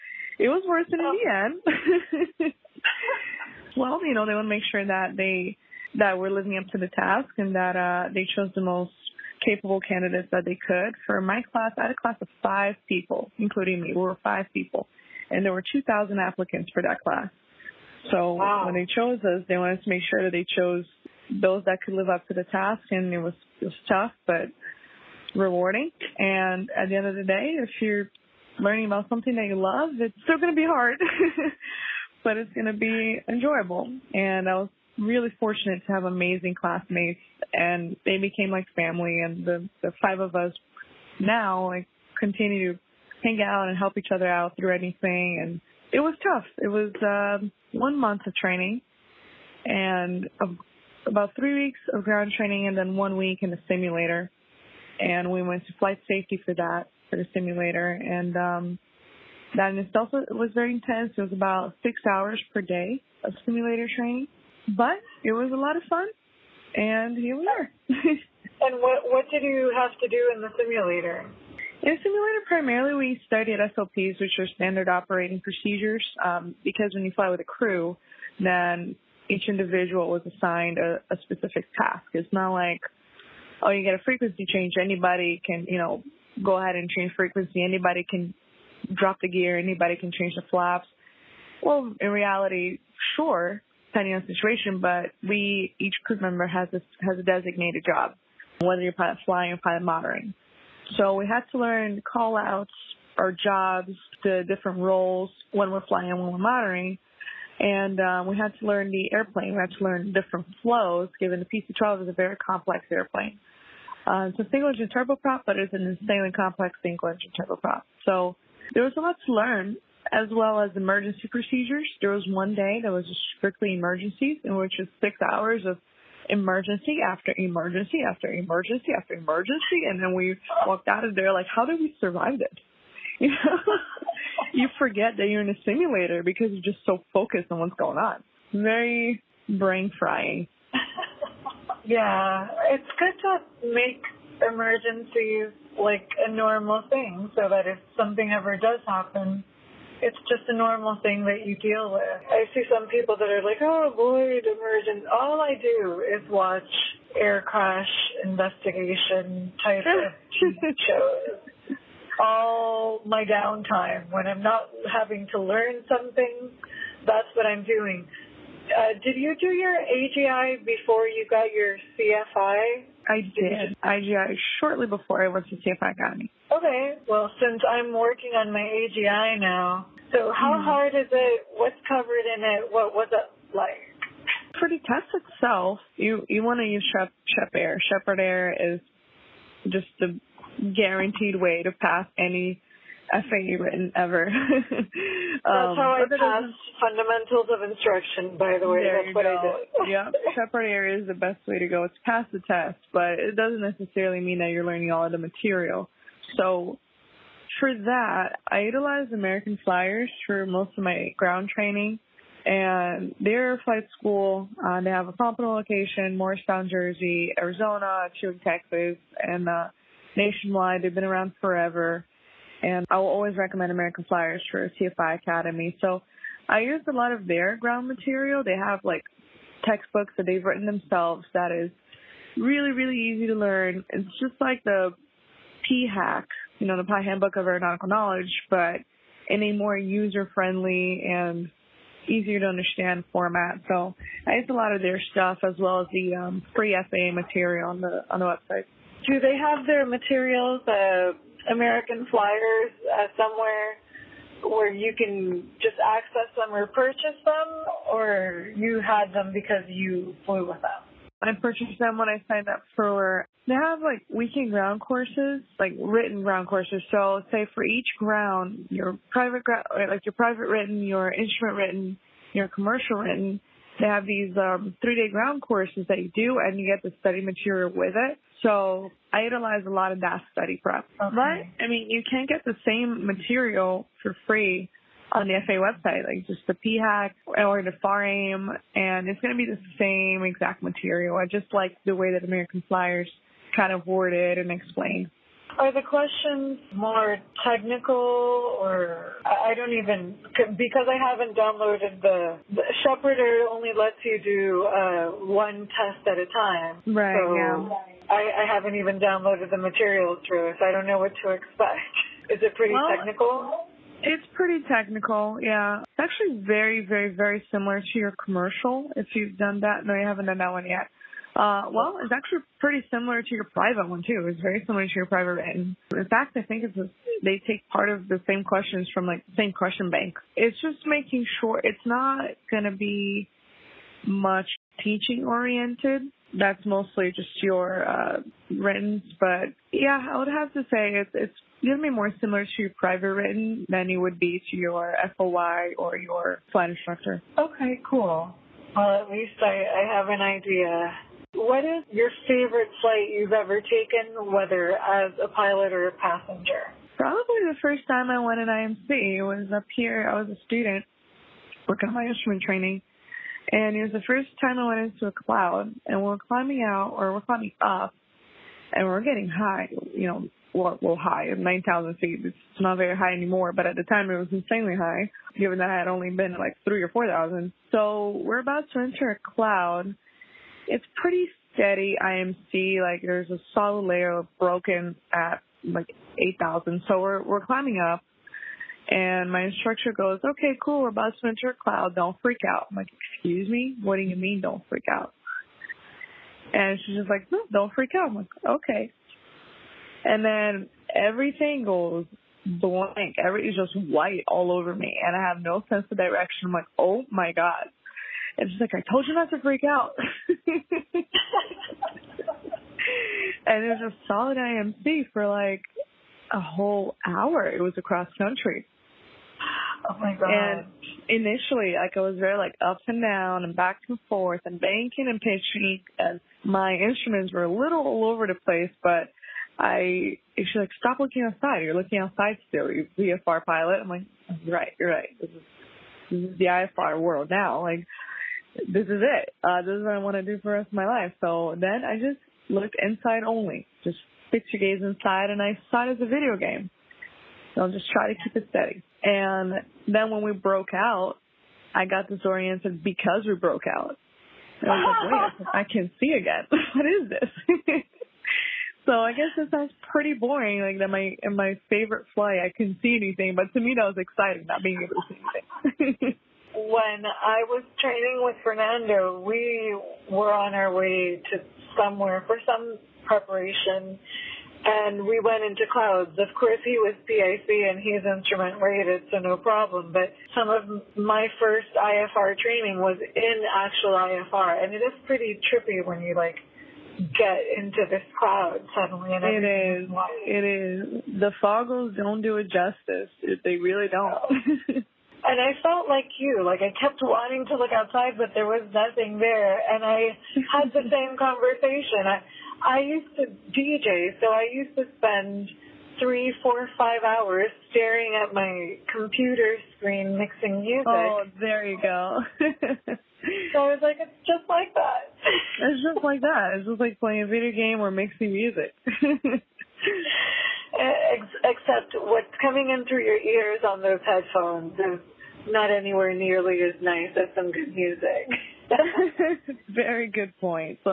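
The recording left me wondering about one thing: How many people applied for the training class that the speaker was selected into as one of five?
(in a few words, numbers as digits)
2000.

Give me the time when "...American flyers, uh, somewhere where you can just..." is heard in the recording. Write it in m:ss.
4:11.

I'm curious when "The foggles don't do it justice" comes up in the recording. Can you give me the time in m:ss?
8:11.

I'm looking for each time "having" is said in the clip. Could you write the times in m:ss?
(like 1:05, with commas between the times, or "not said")
2:44.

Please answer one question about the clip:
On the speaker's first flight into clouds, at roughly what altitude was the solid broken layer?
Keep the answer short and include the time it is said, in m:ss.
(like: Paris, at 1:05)
8,000 feet, at 6:26.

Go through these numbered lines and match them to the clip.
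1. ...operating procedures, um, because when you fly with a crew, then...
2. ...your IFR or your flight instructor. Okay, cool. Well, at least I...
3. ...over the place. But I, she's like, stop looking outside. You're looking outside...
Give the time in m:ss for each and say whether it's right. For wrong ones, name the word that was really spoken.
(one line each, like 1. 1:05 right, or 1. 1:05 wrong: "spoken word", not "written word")
1. 1:14 right
2. 5:44 wrong: "FOI", not "IFR"
3. 7:08 right.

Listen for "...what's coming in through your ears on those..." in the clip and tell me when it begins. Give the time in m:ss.
8:42.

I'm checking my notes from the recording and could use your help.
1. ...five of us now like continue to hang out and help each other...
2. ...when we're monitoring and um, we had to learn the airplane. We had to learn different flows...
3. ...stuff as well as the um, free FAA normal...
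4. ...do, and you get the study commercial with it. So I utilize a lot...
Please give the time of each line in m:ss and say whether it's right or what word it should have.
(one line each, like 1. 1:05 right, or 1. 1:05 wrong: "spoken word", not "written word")
1. 0:40 right
2. 1:46 right
3. 4:05 wrong: "material", not "normal"
4. 4:36 wrong: "material", not "commercial".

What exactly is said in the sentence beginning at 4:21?
I purchased them when I signed up for.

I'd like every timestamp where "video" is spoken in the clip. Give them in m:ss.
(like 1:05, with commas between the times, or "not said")
7:26, 8:37.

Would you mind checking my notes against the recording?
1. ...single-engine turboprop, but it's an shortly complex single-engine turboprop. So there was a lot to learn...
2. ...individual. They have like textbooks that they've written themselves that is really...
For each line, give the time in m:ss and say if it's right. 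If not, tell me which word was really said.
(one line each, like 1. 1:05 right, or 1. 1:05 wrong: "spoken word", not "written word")
1. 1:54 wrong: "insanely", not "shortly"
2. 3:47 wrong: "material", not "individual".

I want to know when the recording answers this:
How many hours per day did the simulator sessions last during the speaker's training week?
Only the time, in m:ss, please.
1:01.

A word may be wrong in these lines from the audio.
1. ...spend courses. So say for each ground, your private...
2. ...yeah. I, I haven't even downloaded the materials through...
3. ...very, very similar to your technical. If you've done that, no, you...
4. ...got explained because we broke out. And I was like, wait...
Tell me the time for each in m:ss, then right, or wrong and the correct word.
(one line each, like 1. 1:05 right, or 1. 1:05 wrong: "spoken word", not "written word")
1. 4:26 wrong: "ground", not "spend"
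2. 5:07 right
3. 5:16 wrong: "commercial", not "technical"
4. 7:31 wrong: "disoriented", not "explained".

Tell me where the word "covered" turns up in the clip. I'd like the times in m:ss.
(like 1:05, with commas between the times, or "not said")
3:01.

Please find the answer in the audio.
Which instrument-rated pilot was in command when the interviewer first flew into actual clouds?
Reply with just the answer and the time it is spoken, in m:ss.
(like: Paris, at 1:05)
Fernando, at 7:48.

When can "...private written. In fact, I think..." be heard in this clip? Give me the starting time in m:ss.
5:25.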